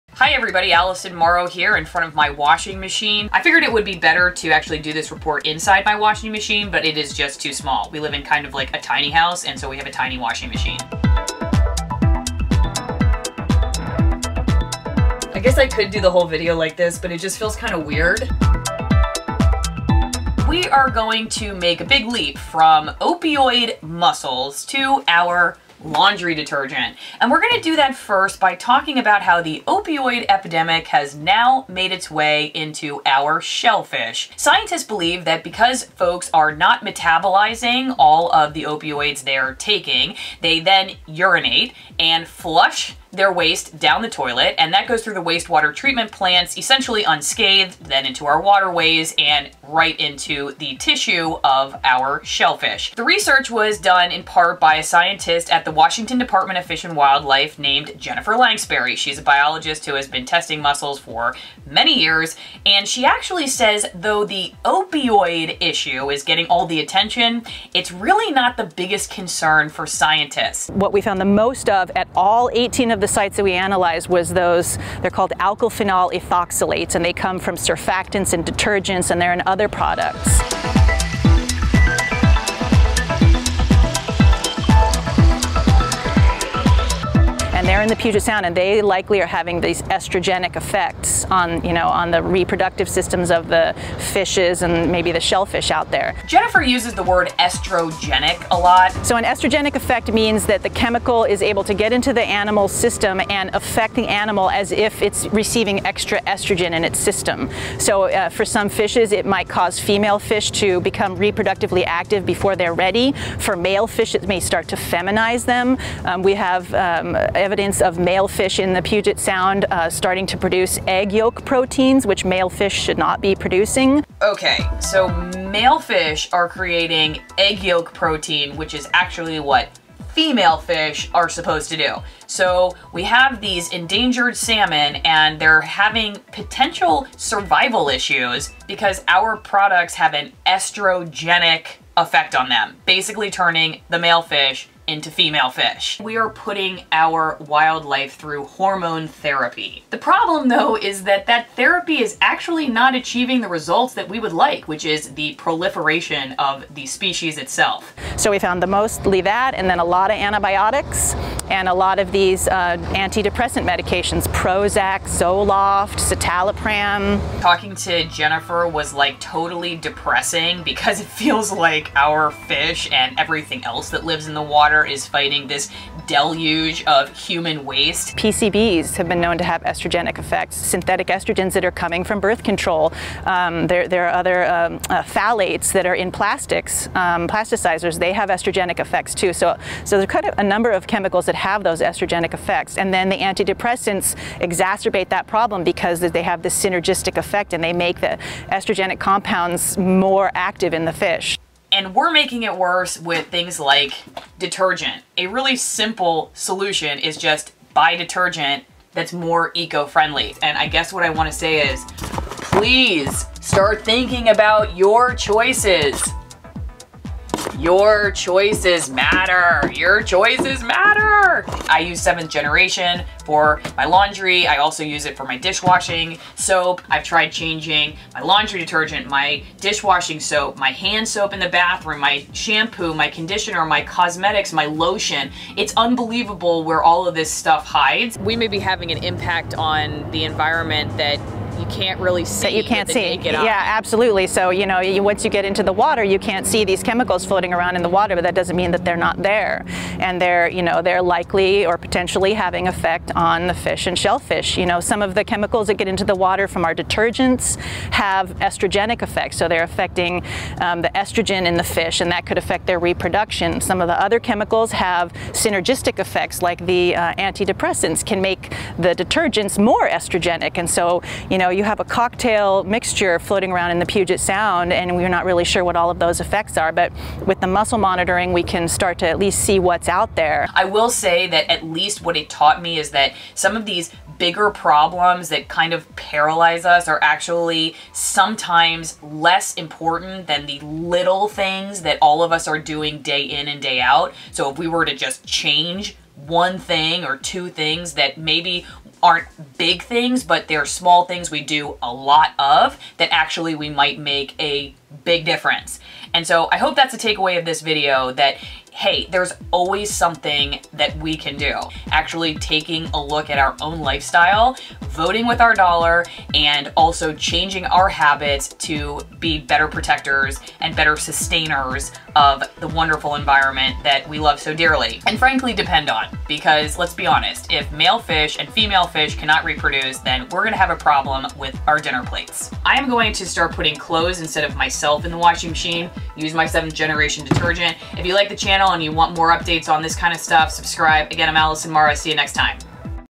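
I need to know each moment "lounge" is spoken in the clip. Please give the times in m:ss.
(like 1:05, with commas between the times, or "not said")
not said.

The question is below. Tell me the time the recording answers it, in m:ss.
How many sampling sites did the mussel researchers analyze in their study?
1:12.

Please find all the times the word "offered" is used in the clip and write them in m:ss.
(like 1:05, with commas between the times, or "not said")
not said.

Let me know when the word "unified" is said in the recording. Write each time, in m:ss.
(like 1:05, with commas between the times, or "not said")
not said.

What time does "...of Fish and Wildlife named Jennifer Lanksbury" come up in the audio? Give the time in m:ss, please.
0:56.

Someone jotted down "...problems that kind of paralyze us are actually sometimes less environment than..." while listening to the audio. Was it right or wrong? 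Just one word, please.
wrong.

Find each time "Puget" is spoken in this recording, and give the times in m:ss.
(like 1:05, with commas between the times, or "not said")
1:27, 1:58, 4:33.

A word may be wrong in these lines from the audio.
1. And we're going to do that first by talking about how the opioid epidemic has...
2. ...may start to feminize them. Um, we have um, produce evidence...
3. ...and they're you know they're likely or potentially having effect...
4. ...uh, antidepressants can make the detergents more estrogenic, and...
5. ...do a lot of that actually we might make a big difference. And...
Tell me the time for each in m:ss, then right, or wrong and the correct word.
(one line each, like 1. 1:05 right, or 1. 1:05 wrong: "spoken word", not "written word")
1. 0:27 right
2. 1:54 wrong: "evidence", not "produce"
3. 4:09 right
4. 4:26 right
5. 5:01 right.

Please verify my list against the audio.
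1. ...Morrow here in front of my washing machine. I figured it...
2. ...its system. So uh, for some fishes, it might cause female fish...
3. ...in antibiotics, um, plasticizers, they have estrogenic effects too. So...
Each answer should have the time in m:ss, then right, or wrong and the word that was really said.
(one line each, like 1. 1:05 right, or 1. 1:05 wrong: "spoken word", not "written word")
1. 0:01 right
2. 1:46 right
3. 3:05 wrong: "plastics", not "antibiotics".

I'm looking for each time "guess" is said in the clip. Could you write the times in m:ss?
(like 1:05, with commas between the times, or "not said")
0:15, 3:30.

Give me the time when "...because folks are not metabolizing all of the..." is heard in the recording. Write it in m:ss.
0:35.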